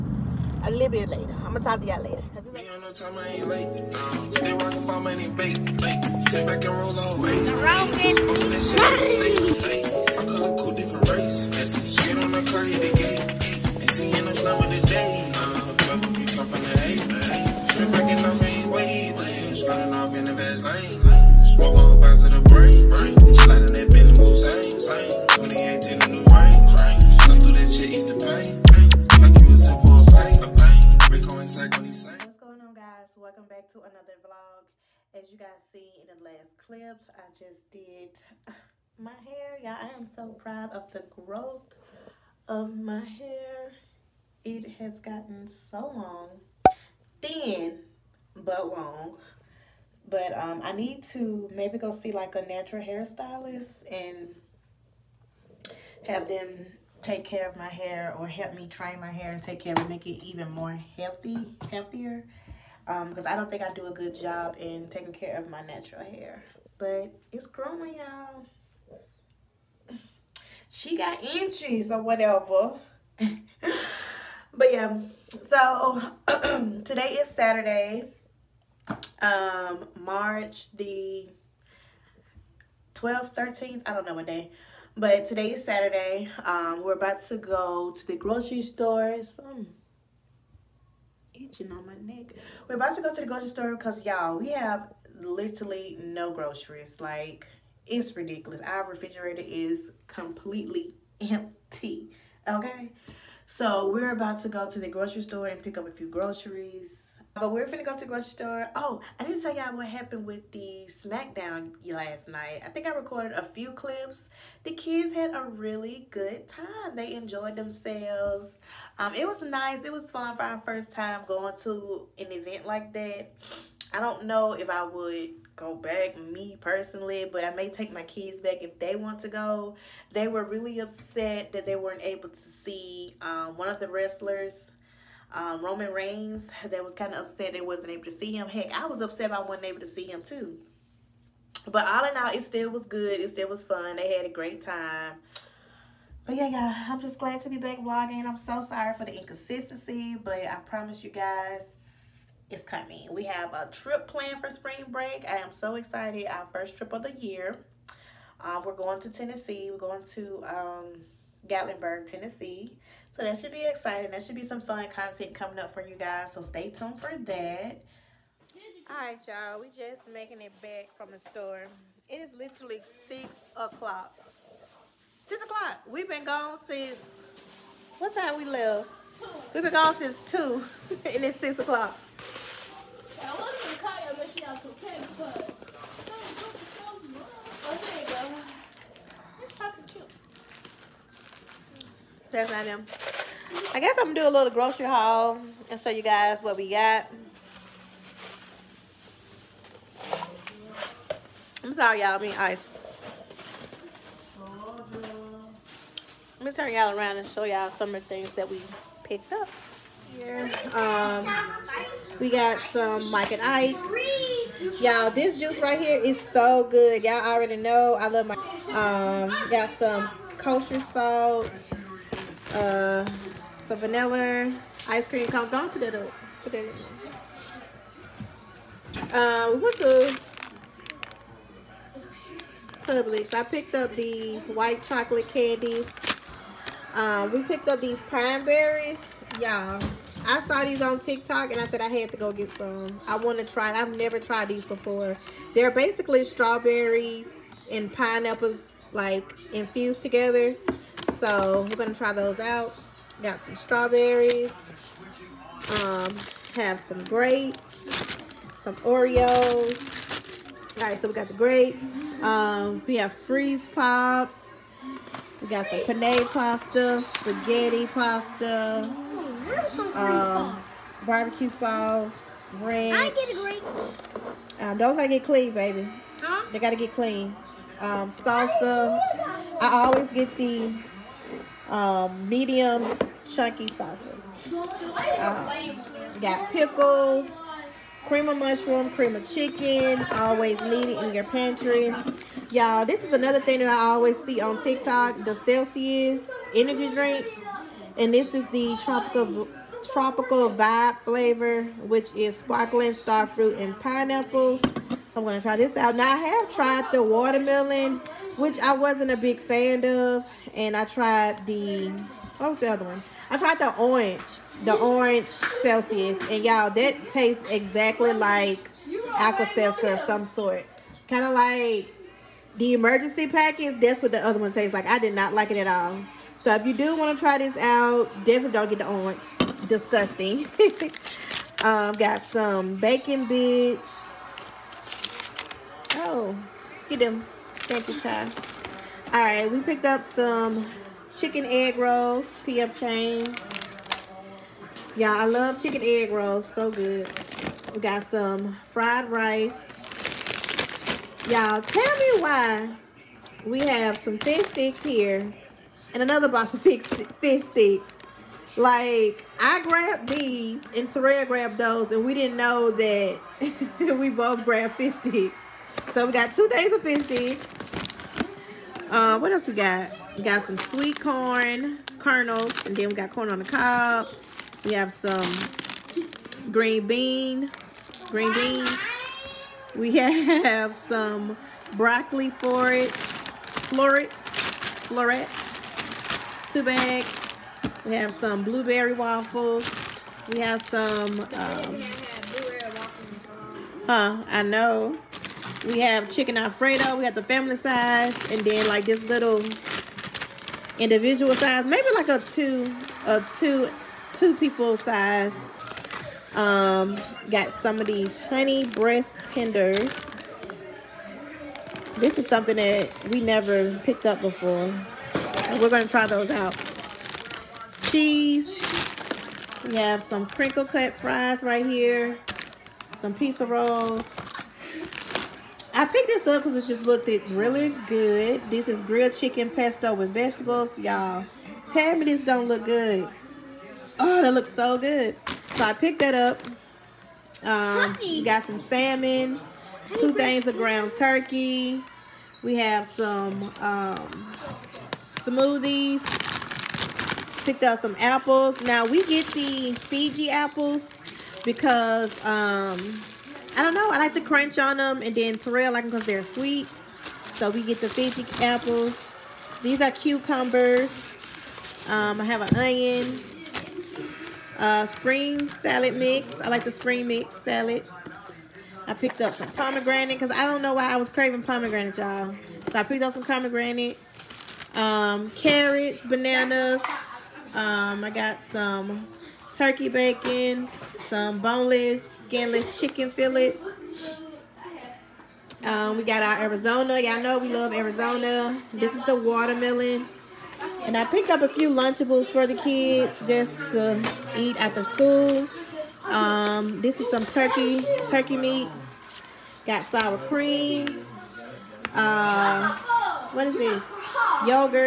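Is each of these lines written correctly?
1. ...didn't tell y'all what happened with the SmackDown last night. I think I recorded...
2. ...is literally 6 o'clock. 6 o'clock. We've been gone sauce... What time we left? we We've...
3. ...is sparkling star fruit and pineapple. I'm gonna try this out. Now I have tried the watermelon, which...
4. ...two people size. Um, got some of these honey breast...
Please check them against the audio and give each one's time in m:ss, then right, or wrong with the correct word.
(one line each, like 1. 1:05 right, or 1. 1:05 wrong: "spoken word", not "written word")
1. 1:49 right
2. 2:52 wrong: "since", not "sauce"
3. 5:02 right
4. 6:44 right.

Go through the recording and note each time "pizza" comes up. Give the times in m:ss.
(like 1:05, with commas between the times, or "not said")
7:03.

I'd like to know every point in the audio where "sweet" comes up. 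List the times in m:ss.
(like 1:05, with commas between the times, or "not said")
6:10, 7:36.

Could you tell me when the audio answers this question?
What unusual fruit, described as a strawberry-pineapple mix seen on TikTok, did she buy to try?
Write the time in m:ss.
3:58.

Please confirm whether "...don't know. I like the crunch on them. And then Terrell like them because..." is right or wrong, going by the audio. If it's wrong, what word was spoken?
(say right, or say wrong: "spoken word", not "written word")
right.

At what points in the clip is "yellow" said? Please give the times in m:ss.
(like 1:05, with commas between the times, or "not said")
not said.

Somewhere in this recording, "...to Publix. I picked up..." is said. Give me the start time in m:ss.
3:49.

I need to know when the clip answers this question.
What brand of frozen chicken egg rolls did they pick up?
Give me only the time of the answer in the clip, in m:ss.
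5:42.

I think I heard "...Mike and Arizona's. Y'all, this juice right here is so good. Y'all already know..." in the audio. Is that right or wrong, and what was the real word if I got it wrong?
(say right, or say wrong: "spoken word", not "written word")
wrong: "Ike", not "Arizona".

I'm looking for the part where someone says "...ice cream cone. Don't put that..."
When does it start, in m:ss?
3:44.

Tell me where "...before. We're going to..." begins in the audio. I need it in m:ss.
6:54.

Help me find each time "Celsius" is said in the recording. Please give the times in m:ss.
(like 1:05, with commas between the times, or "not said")
4:55, 5:15.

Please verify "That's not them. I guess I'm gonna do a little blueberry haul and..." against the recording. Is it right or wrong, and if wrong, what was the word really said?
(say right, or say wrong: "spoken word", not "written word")
wrong: "grocery", not "blueberry".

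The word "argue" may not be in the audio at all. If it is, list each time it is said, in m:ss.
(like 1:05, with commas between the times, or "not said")
not said.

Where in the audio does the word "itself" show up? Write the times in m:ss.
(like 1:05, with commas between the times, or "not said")
not said.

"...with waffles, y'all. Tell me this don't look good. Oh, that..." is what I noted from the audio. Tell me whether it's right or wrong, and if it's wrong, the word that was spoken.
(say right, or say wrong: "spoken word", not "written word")
wrong: "vegetables", not "waffles".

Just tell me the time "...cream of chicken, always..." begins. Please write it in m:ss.
4:48.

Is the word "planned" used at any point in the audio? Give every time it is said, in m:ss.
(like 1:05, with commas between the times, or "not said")
2:34.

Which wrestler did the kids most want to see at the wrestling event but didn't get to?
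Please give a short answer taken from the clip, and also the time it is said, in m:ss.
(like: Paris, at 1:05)
Roman Reigns, at 2:15.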